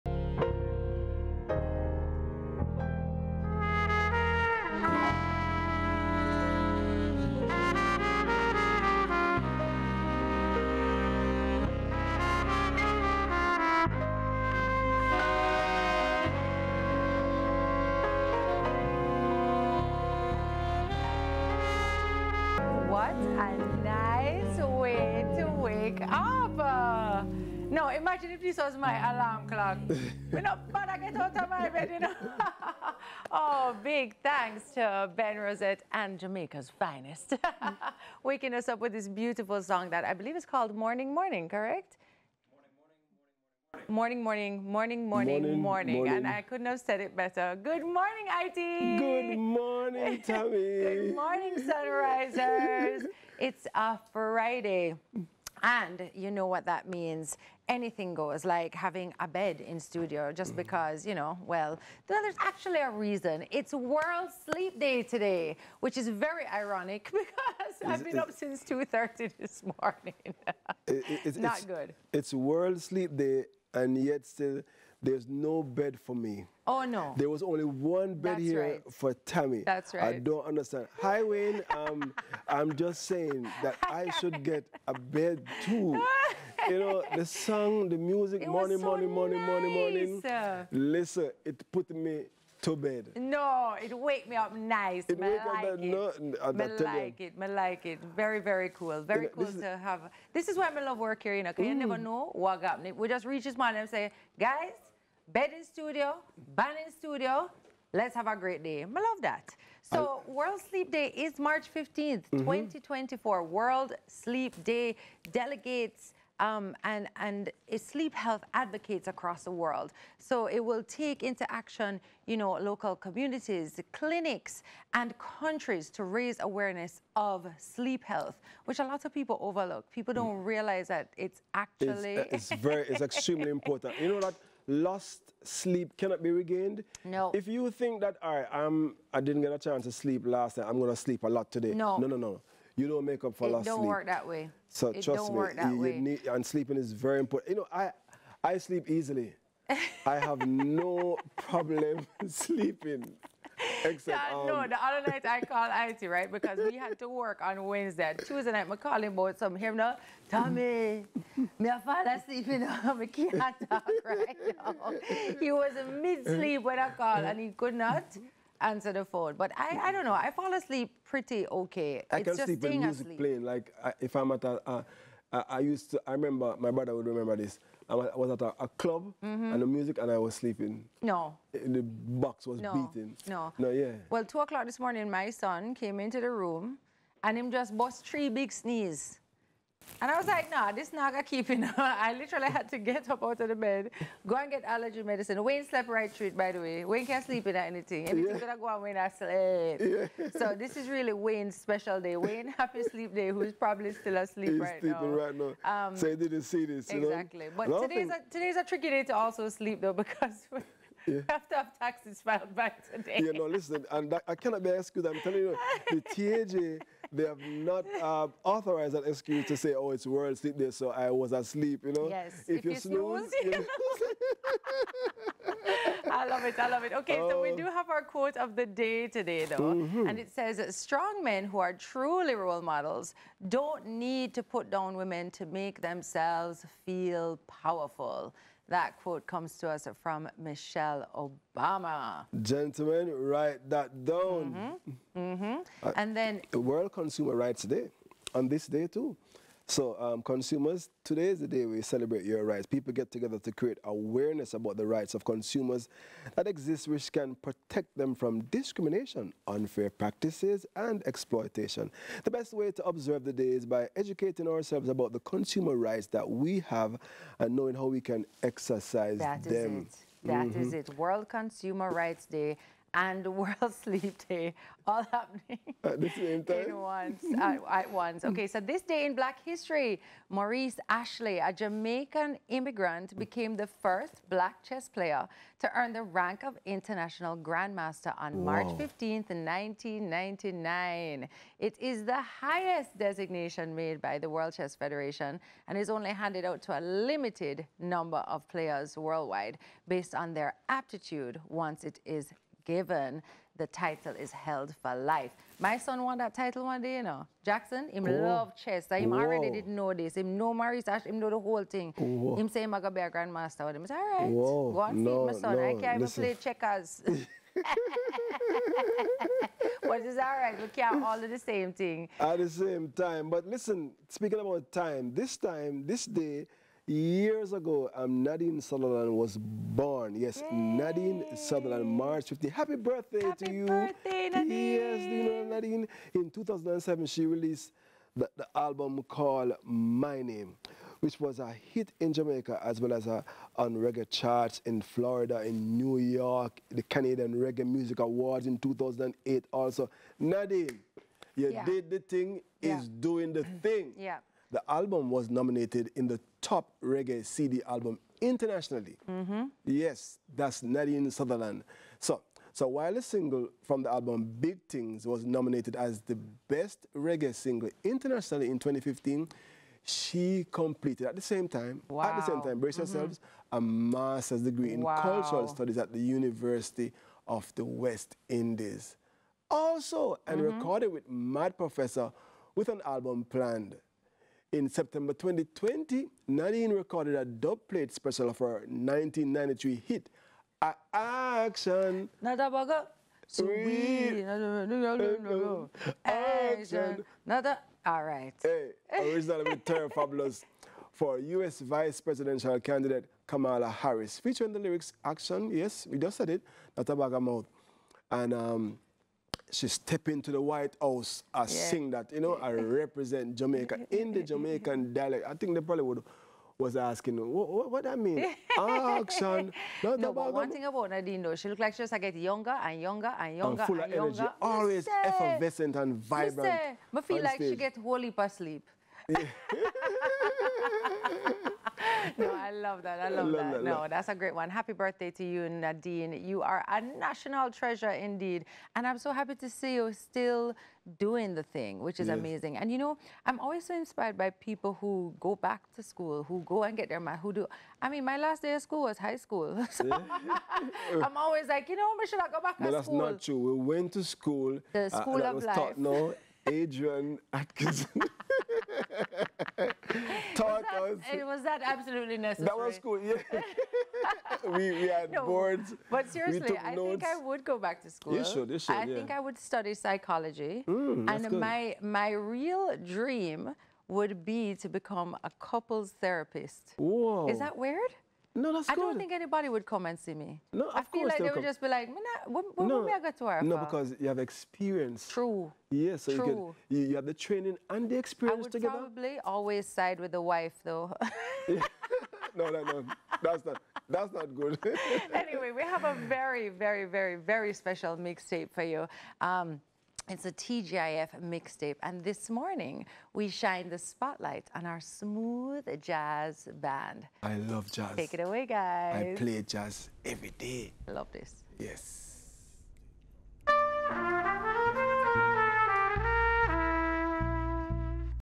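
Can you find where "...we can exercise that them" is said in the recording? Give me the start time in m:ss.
4:27.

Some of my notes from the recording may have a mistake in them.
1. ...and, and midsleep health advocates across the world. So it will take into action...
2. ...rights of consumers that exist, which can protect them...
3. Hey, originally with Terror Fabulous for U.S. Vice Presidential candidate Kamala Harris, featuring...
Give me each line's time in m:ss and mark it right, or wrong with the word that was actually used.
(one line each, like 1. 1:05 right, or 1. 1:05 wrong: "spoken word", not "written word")
1. 1:56 wrong: "sleep", not "midsleep"
2. 4:14 right
3. 6:38 right.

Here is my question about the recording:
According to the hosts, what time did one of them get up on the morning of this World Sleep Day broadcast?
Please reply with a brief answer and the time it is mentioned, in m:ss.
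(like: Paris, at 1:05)
2.30, at 1:08.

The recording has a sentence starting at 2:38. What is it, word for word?
Tuesday night, I called him about some him now.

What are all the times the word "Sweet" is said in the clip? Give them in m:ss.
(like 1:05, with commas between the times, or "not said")
6:33.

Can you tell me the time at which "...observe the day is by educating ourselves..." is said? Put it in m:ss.
4:22.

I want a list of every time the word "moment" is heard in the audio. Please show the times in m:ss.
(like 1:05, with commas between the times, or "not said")
not said.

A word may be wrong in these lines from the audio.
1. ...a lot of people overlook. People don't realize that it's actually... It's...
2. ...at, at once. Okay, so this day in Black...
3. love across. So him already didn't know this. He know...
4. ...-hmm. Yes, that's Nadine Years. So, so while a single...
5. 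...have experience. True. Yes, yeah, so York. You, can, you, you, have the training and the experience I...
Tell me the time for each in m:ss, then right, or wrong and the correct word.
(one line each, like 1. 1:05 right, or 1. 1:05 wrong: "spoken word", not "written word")
1. 2:08 right
2. 4:37 right
3. 5:08 wrong: "chess", not "across"
4. 5:59 wrong: "Sutherland", not "Years"
5. 8:04 wrong: "True", not "York".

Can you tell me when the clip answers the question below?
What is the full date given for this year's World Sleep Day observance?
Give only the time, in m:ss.
1:51.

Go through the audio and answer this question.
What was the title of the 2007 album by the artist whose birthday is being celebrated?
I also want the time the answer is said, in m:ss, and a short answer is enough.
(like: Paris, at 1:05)
My Name, at 5:39.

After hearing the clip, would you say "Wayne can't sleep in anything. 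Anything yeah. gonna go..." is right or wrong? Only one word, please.
right.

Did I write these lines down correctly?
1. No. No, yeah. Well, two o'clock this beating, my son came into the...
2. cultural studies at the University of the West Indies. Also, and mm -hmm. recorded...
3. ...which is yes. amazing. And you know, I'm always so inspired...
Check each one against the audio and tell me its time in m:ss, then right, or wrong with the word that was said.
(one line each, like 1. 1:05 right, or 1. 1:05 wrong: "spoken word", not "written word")
1. 3:03 wrong: "morning", not "beating"
2. 6:15 right
3. 7:21 right.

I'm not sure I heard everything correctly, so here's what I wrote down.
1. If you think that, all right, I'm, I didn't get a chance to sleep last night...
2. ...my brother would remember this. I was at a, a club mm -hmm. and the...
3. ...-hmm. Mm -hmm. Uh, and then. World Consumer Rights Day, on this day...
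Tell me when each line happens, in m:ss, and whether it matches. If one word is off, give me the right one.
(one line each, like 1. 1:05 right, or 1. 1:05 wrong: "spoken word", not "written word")
1. 2:17 right
2. 2:56 right
3. 4:04 right.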